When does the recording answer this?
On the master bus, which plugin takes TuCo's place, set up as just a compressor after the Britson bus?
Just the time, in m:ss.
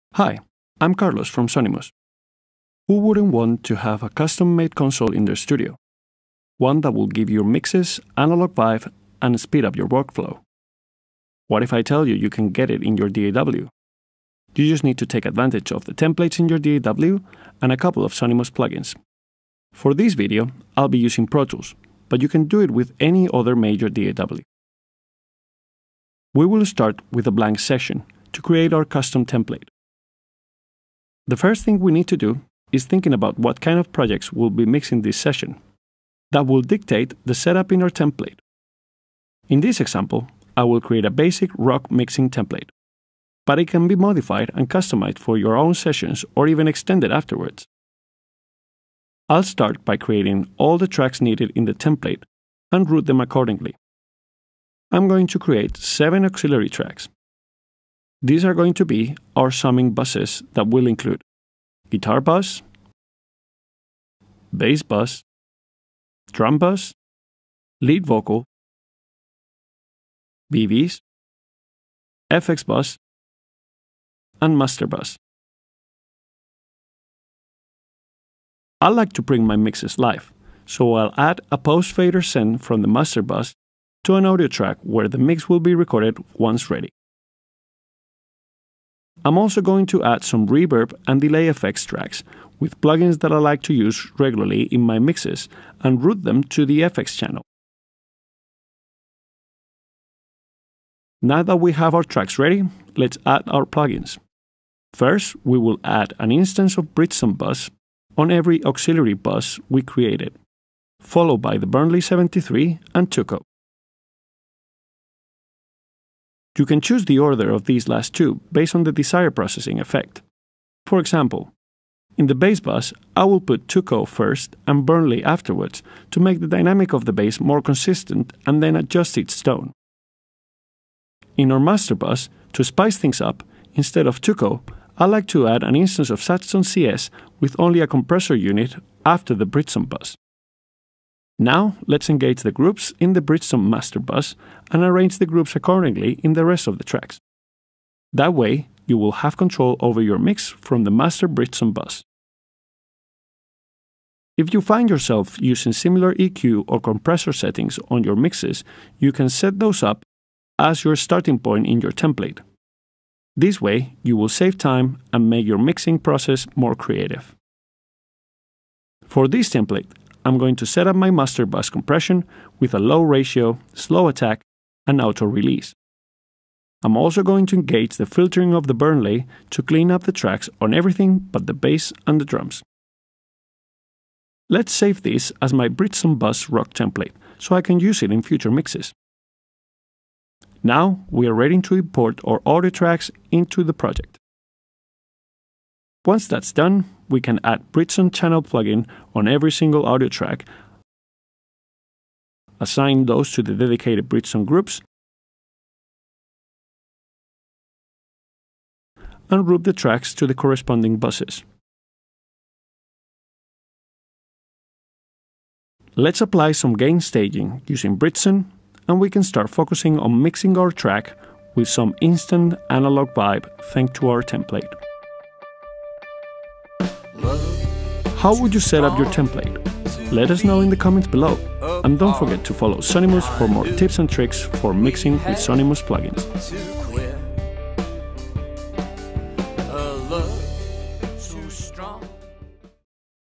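2:16.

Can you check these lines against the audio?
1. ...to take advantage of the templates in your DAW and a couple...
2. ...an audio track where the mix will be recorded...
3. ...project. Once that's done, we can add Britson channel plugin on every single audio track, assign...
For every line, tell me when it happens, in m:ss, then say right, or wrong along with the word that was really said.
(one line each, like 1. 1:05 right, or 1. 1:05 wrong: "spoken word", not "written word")
1. 0:14 right
2. 1:24 right
3. 3:13 right.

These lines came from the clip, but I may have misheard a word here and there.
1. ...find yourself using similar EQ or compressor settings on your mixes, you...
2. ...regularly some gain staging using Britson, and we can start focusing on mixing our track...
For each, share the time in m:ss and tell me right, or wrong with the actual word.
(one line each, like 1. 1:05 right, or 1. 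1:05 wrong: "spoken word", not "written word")
1. 2:34 right
2. 3:36 wrong: "apply", not "regularly".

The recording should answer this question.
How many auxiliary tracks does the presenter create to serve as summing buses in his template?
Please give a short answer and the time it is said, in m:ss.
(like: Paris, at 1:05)
7, at 0:55.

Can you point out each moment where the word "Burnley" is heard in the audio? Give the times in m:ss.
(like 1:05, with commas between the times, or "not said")
1:51, 2:04, 2:58.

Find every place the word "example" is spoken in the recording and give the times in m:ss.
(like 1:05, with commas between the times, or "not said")
0:39, 2:00.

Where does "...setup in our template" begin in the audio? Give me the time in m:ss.
0:37.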